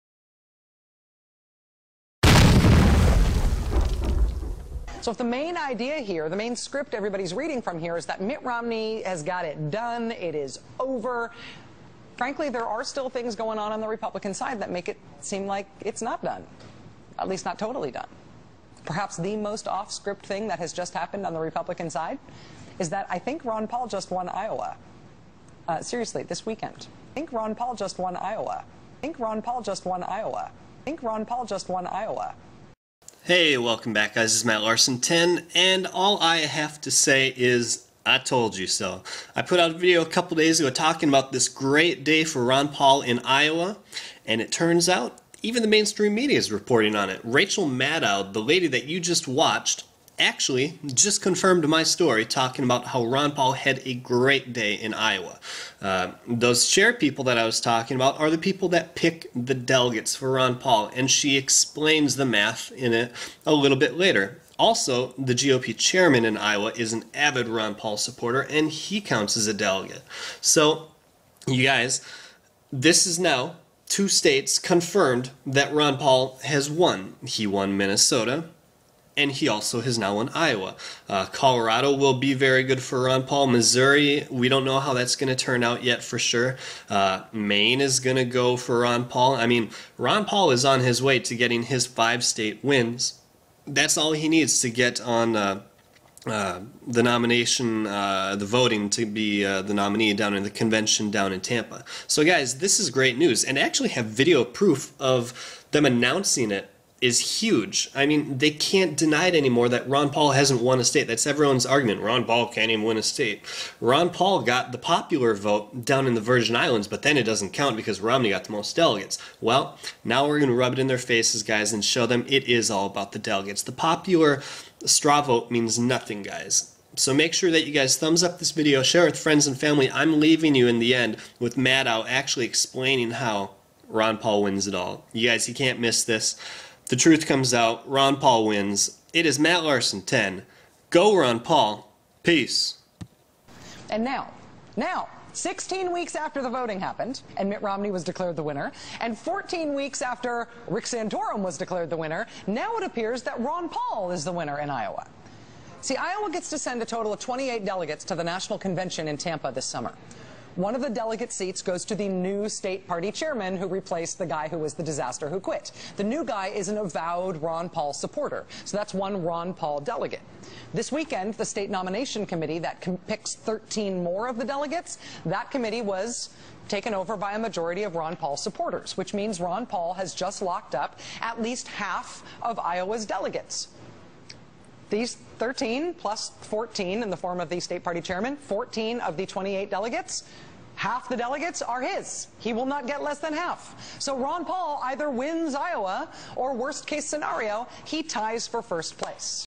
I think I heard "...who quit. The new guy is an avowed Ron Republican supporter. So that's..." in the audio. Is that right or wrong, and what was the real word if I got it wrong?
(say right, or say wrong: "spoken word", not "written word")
wrong: "Paul", not "Republican".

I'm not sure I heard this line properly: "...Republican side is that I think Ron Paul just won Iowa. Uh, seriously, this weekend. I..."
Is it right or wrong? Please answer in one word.
right.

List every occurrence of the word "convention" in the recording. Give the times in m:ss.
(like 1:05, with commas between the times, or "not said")
1:40, 2:38.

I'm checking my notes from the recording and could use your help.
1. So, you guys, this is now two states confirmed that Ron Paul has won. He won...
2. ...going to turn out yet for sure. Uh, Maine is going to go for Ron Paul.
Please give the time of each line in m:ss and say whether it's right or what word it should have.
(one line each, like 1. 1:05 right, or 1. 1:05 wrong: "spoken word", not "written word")
1. 1:10 right
2. 1:25 right.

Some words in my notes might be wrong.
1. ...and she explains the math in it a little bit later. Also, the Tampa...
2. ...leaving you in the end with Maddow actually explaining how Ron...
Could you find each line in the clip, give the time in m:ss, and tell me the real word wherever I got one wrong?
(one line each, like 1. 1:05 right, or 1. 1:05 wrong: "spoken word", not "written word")
1. 1:00 wrong: "GOP", not "Tampa"
2. 2:10 right.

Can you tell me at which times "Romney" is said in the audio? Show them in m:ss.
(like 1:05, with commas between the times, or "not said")
0:08, 1:58, 2:27.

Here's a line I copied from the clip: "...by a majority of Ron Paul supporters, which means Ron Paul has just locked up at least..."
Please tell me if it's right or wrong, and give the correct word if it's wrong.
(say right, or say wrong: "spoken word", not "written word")
right.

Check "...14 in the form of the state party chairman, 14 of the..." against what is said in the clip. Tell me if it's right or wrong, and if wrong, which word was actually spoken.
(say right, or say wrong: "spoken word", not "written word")
right.